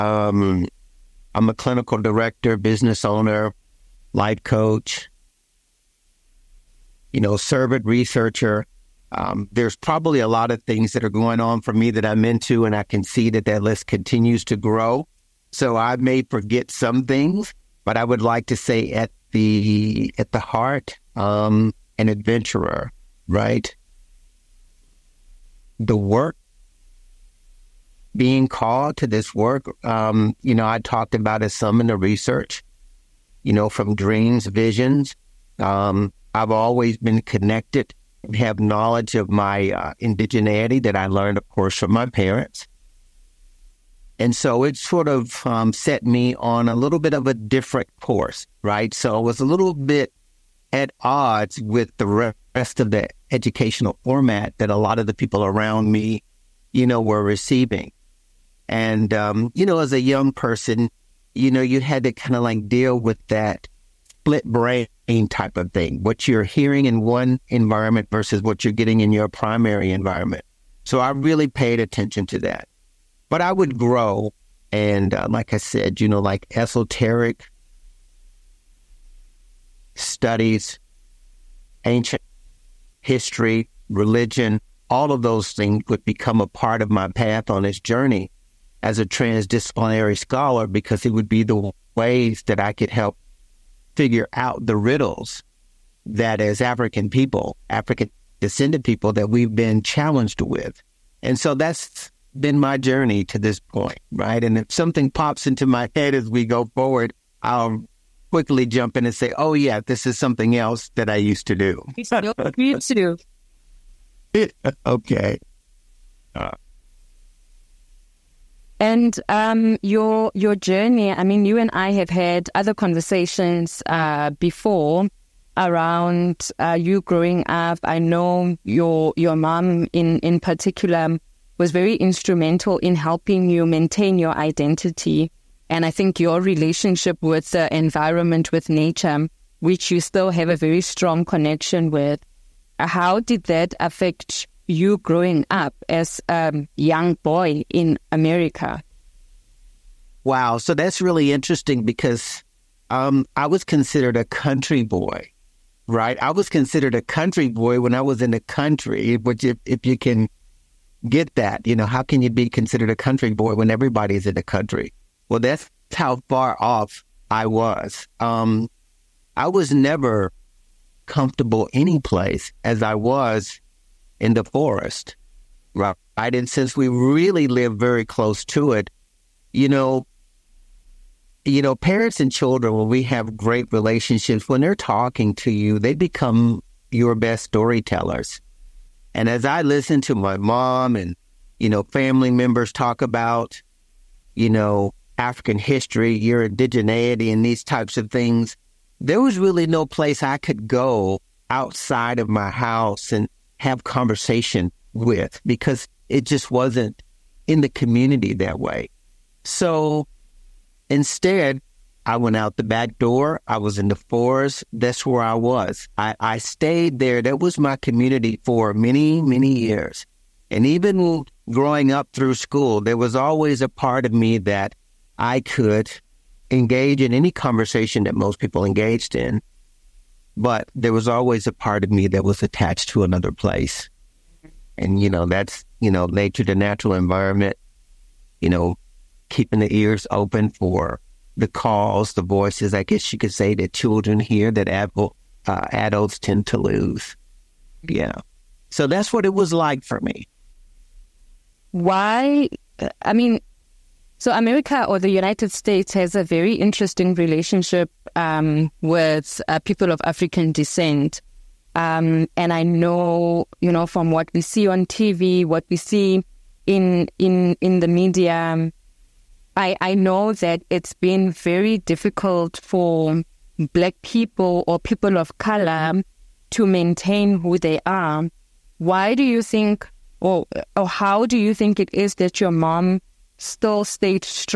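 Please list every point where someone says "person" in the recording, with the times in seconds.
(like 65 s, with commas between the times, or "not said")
60 s.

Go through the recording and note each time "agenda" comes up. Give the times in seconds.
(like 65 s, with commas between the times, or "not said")
not said.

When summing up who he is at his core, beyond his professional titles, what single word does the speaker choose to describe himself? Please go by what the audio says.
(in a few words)
adventurer.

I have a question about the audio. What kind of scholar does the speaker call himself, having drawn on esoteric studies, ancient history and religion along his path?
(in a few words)
transdisciplinary scholar.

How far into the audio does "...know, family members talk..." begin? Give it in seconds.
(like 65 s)
191 s.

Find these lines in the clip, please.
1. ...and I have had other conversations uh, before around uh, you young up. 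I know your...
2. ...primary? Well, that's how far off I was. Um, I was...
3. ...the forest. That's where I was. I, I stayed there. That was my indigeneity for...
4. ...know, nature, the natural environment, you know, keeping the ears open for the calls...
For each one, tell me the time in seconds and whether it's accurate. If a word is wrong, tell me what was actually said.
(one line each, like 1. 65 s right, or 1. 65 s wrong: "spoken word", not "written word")
1. 121 s wrong: "growing", not "young"
2. 164 s wrong: "country", not "primary"
3. 213 s wrong: "community", not "indigeneity"
4. 235 s right.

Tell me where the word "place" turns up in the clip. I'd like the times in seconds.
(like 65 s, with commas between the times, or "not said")
171 s, 199 s, 233 s.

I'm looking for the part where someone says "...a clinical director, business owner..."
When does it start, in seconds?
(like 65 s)
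1 s.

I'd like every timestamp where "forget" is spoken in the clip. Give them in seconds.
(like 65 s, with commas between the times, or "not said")
16 s.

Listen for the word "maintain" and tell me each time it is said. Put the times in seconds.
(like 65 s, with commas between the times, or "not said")
133 s, 276 s.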